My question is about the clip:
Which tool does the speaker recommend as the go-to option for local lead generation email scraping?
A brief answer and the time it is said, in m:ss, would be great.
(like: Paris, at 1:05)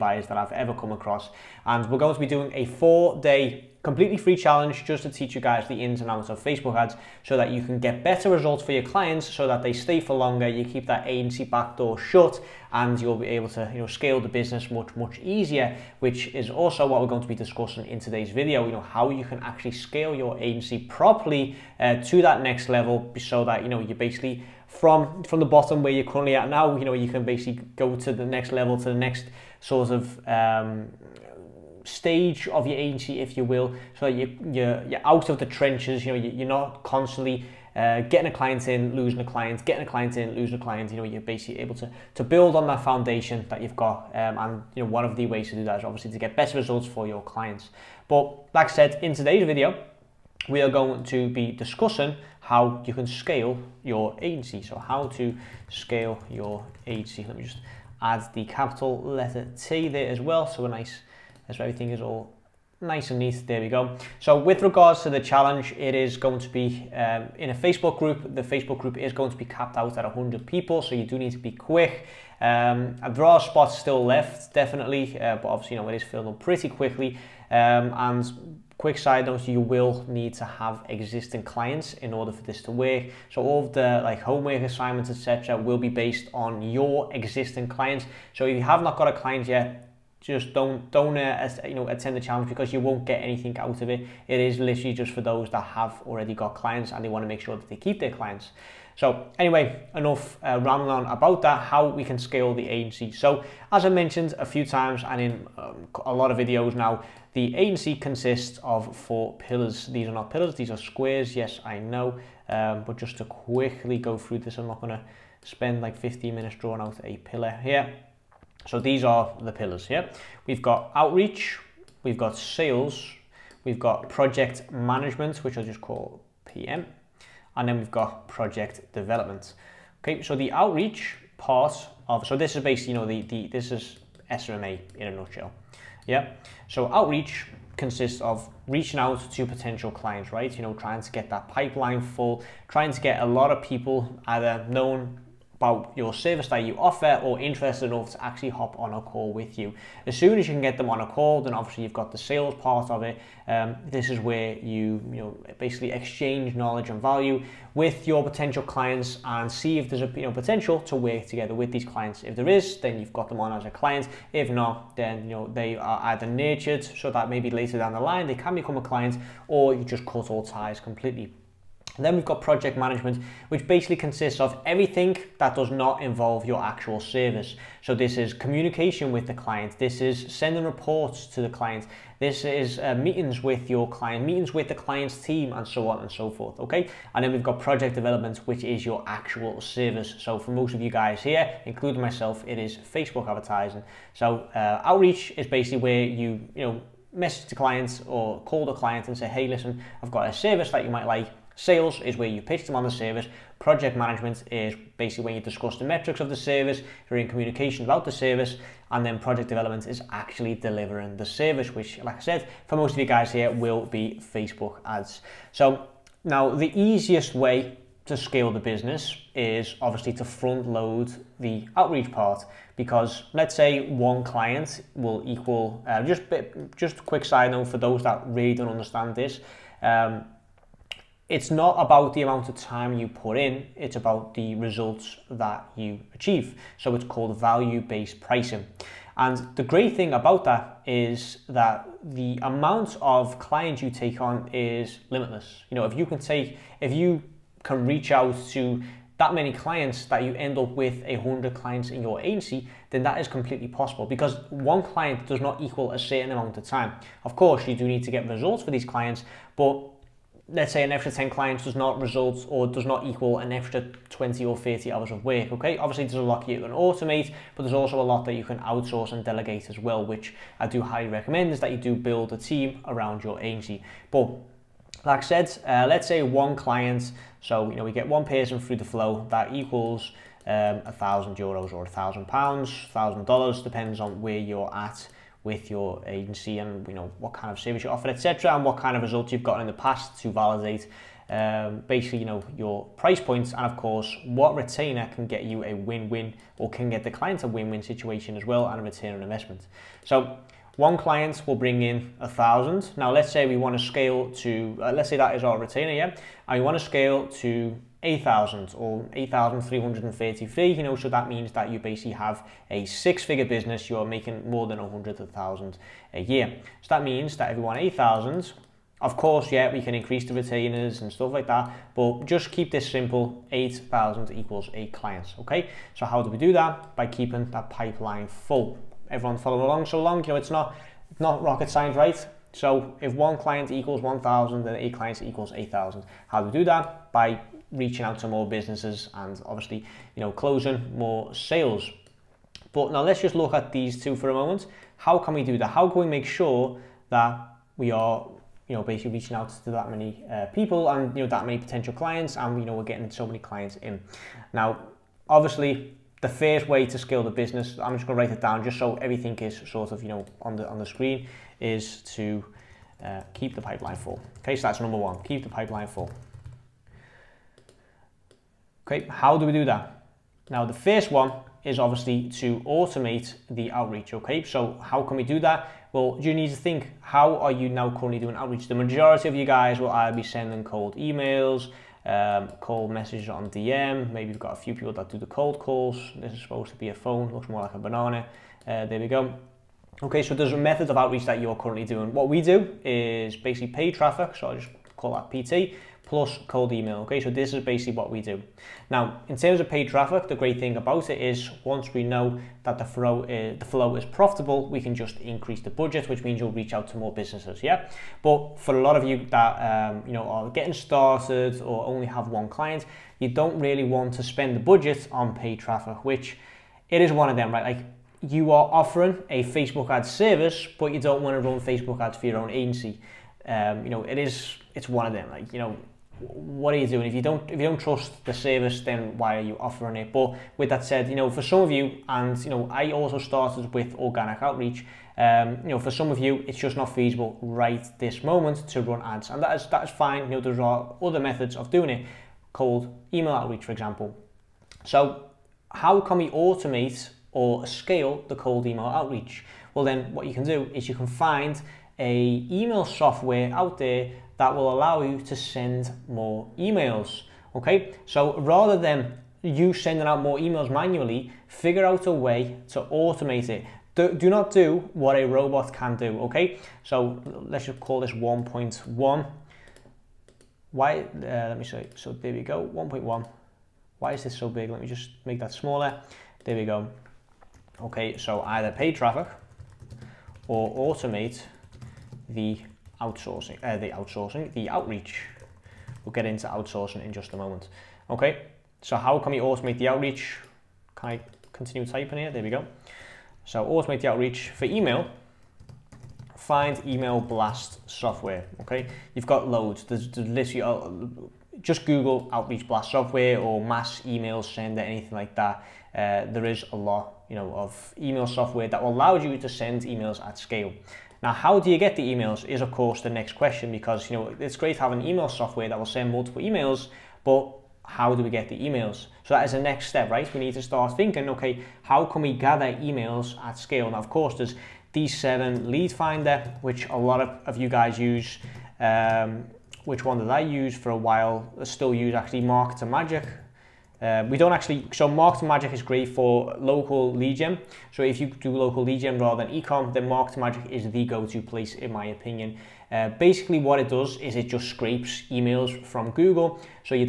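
Marketer Magic, at 8:52.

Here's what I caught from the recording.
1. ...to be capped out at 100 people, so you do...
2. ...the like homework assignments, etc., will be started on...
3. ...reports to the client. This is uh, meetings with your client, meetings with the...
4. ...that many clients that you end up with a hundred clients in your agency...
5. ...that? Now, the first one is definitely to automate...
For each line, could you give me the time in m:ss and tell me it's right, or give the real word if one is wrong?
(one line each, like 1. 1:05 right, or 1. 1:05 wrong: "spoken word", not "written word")
1. 1:09 right
2. 1:23 wrong: "based", not "started"
3. 3:00 right
4. 4:09 right
5. 6:09 wrong: "obviously", not "definitely".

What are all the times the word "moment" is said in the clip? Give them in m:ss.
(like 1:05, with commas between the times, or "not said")
5:44, 7:18, 8:07.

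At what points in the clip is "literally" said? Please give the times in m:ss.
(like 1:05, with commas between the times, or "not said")
1:34, 8:20.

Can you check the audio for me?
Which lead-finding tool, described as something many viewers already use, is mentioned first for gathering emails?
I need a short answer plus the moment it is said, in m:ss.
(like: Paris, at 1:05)
D7 Lead Finder, at 8:44.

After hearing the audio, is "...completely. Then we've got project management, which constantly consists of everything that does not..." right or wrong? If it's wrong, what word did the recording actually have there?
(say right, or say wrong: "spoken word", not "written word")
wrong: "basically", not "constantly".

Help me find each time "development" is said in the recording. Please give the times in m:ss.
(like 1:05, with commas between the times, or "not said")
2:08, 3:07, 3:29.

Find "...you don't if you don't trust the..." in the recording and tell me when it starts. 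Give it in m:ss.
7:07.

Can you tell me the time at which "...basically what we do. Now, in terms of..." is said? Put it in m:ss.
6:37.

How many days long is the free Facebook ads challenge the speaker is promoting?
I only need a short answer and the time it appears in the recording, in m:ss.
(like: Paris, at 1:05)
4, at 0:02.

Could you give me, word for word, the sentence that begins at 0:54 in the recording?
So how to scale your agency.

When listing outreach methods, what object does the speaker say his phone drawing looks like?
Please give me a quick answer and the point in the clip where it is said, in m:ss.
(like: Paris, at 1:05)
a banana, at 6:27.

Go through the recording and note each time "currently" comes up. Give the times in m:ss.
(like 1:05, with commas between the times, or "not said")
0:26, 6:17, 6:31.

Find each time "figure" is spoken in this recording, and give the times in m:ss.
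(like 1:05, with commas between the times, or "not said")
5:13, 7:41.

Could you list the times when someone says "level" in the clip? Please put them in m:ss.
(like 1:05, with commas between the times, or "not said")
0:22, 0:28.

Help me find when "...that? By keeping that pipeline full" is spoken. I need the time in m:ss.
5:26.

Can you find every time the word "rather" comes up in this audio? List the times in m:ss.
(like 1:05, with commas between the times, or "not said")
7:38, 8:59.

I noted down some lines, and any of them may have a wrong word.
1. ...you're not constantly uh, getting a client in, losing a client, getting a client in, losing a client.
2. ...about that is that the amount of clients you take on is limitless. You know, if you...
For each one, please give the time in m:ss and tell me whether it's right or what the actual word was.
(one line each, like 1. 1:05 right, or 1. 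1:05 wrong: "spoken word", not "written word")
1. 0:36 right
2. 4:00 right.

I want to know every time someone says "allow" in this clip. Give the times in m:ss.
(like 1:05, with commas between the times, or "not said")
7:34, 8:28.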